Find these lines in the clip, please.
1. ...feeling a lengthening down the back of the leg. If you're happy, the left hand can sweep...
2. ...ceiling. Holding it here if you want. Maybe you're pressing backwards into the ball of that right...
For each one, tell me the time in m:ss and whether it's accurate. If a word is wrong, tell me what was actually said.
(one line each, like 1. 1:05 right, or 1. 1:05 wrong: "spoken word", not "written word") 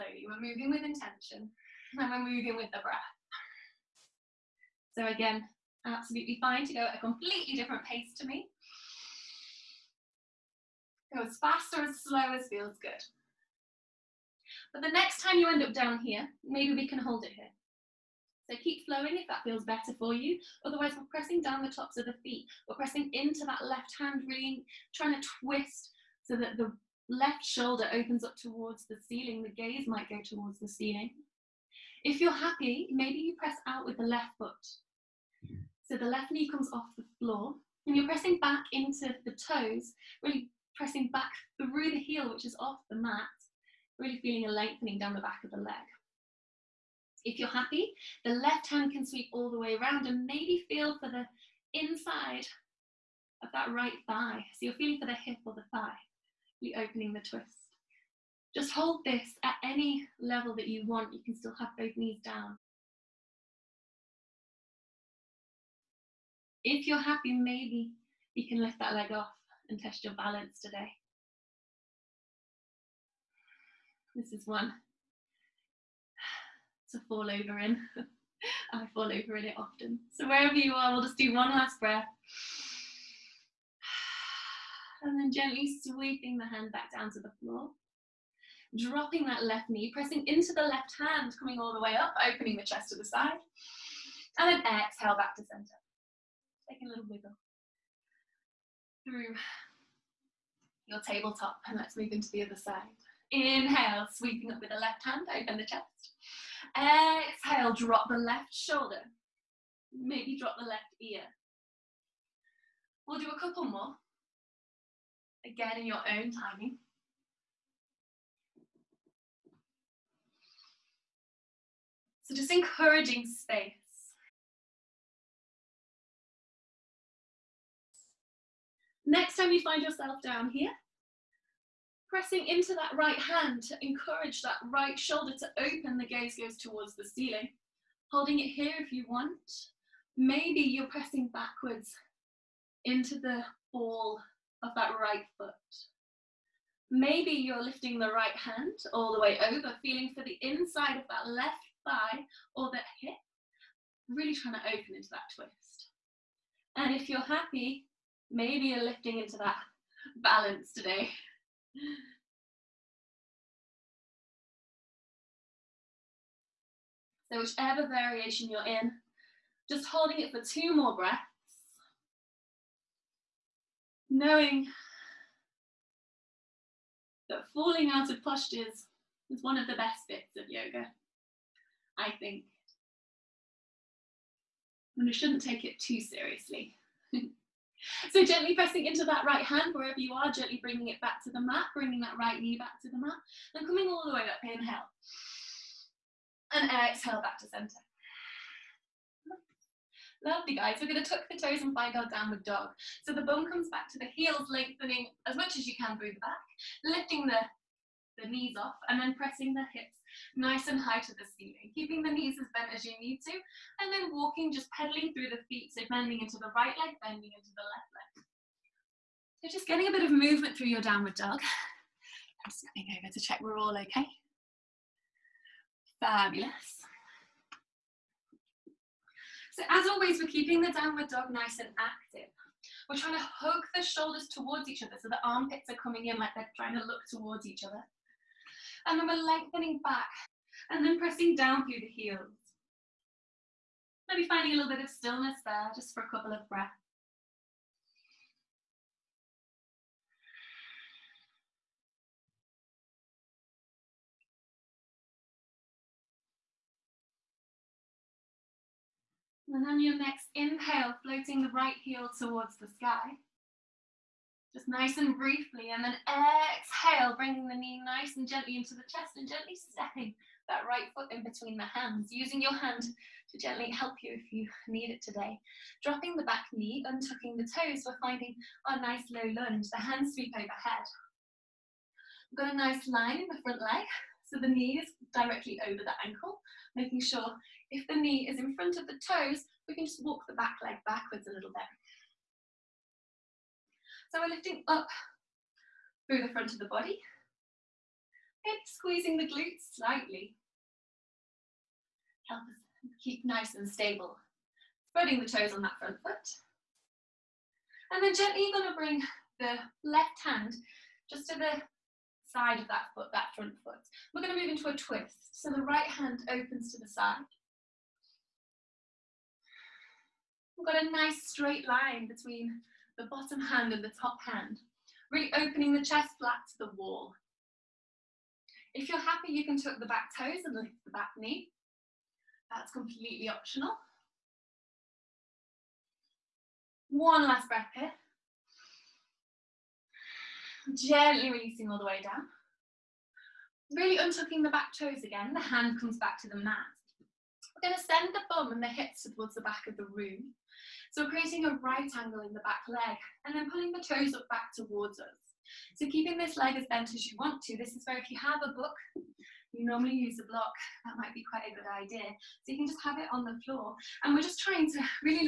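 1. 0:44 right
2. 2:17 right.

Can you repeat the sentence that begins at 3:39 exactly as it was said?
So just getting a bit of movement through your downward dog.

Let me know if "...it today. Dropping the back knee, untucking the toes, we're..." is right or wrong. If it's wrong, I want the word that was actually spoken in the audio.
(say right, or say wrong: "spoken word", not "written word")
right.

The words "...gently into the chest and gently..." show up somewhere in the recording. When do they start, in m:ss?
4:28.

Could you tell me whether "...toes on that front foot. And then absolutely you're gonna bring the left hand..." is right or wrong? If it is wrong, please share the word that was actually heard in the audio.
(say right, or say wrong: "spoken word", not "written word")
wrong: "gently", not "absolutely".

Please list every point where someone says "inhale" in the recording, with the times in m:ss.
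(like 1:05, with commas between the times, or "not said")
1:43, 3:14, 4:20.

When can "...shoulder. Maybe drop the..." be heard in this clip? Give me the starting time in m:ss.
1:48.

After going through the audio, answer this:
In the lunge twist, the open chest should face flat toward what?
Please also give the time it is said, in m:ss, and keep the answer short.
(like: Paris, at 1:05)
The wall, at 5:26.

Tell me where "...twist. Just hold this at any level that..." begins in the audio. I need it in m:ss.
0:57.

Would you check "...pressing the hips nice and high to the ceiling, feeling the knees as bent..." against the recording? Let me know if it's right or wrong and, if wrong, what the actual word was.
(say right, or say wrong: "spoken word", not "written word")
wrong: "keeping", not "feeling".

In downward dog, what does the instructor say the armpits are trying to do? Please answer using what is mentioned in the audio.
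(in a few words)
Look towards each other.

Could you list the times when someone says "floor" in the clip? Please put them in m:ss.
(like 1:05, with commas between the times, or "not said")
0:37, 1:27, 6:03.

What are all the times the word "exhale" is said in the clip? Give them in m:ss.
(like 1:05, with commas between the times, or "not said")
1:34, 1:46, 3:16, 4:26.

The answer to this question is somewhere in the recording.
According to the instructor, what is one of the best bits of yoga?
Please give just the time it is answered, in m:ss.
2:57.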